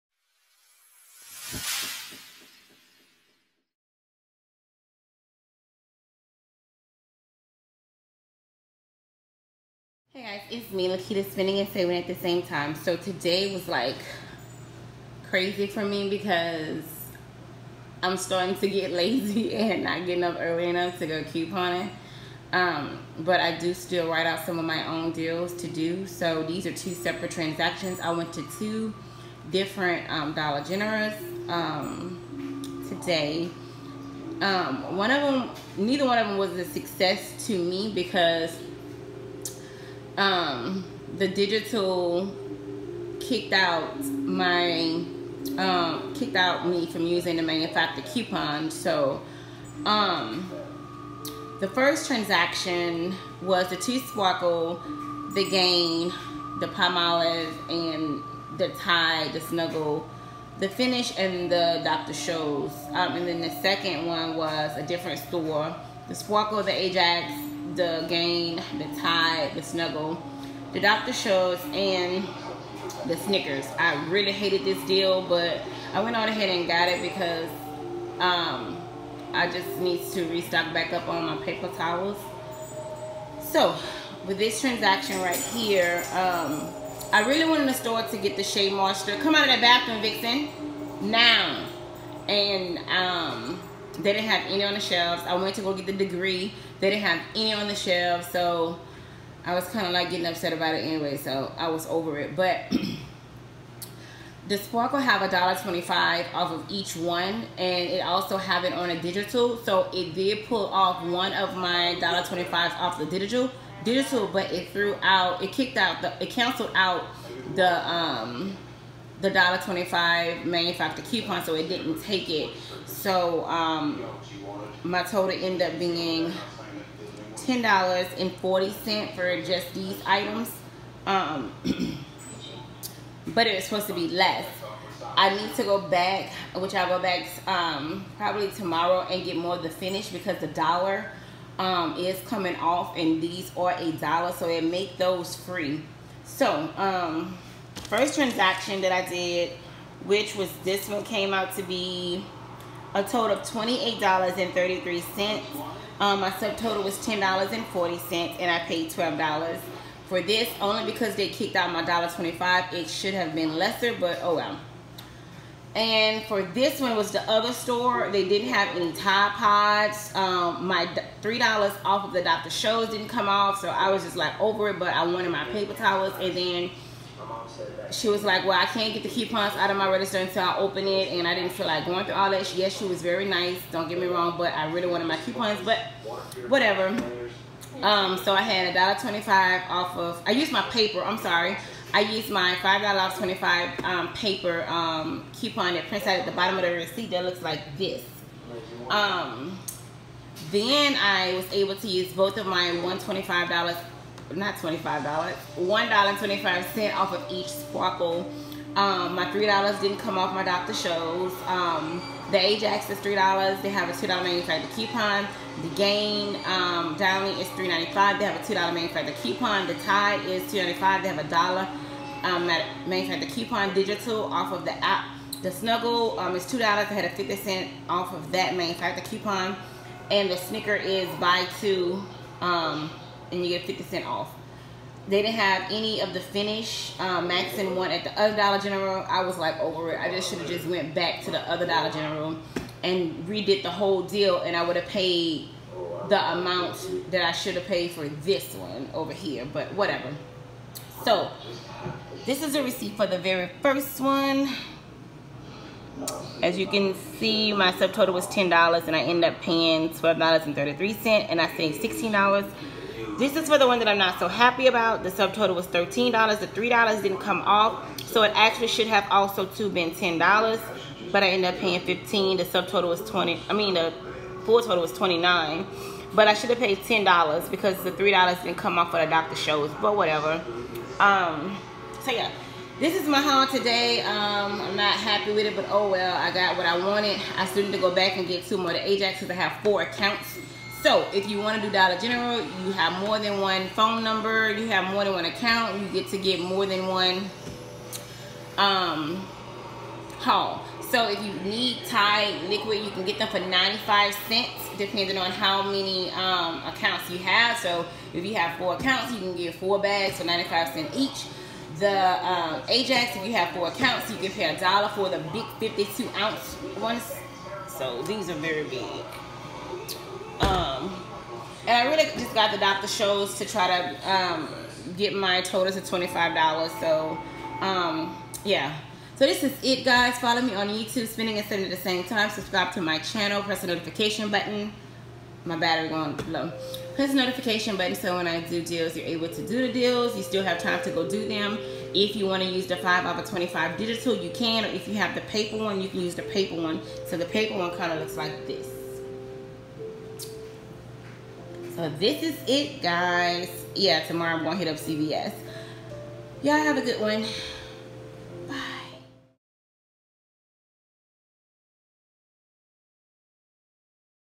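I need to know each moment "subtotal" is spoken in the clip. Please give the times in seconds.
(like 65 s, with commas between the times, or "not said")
156 s, 257 s, 265 s, 272 s.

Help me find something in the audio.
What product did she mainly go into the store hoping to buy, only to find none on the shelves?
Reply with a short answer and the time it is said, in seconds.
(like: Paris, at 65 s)
Shea Moisture, at 88 s.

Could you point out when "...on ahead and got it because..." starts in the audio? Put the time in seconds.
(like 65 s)
76 s.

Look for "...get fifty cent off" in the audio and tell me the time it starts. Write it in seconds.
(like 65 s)
233 s.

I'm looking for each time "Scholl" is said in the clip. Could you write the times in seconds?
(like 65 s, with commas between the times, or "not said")
62 s, 71 s, 172 s, 210 s, 279 s, 322 s.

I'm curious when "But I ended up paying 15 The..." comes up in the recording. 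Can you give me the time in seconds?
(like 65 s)
271 s.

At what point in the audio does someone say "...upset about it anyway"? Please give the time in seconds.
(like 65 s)
100 s.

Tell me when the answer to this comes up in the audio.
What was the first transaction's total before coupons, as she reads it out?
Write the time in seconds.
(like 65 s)
153 s.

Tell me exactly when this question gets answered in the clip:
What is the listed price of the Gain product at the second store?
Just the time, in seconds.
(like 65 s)
217 s.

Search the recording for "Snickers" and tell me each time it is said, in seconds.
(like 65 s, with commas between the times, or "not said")
73 s, 230 s.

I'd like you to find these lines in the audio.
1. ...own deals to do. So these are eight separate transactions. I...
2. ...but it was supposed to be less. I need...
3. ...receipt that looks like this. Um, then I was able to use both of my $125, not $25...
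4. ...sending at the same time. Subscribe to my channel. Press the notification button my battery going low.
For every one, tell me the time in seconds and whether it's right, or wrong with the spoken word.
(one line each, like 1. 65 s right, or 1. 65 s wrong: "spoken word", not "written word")
1. 24 s wrong: "two", not "eight"
2. 133 s right
3. 196 s right
4. 331 s right.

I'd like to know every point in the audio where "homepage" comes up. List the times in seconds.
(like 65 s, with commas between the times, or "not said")
not said.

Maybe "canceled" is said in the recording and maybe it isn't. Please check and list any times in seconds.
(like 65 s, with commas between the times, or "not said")
116 s.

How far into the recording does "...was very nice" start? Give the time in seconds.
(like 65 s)
182 s.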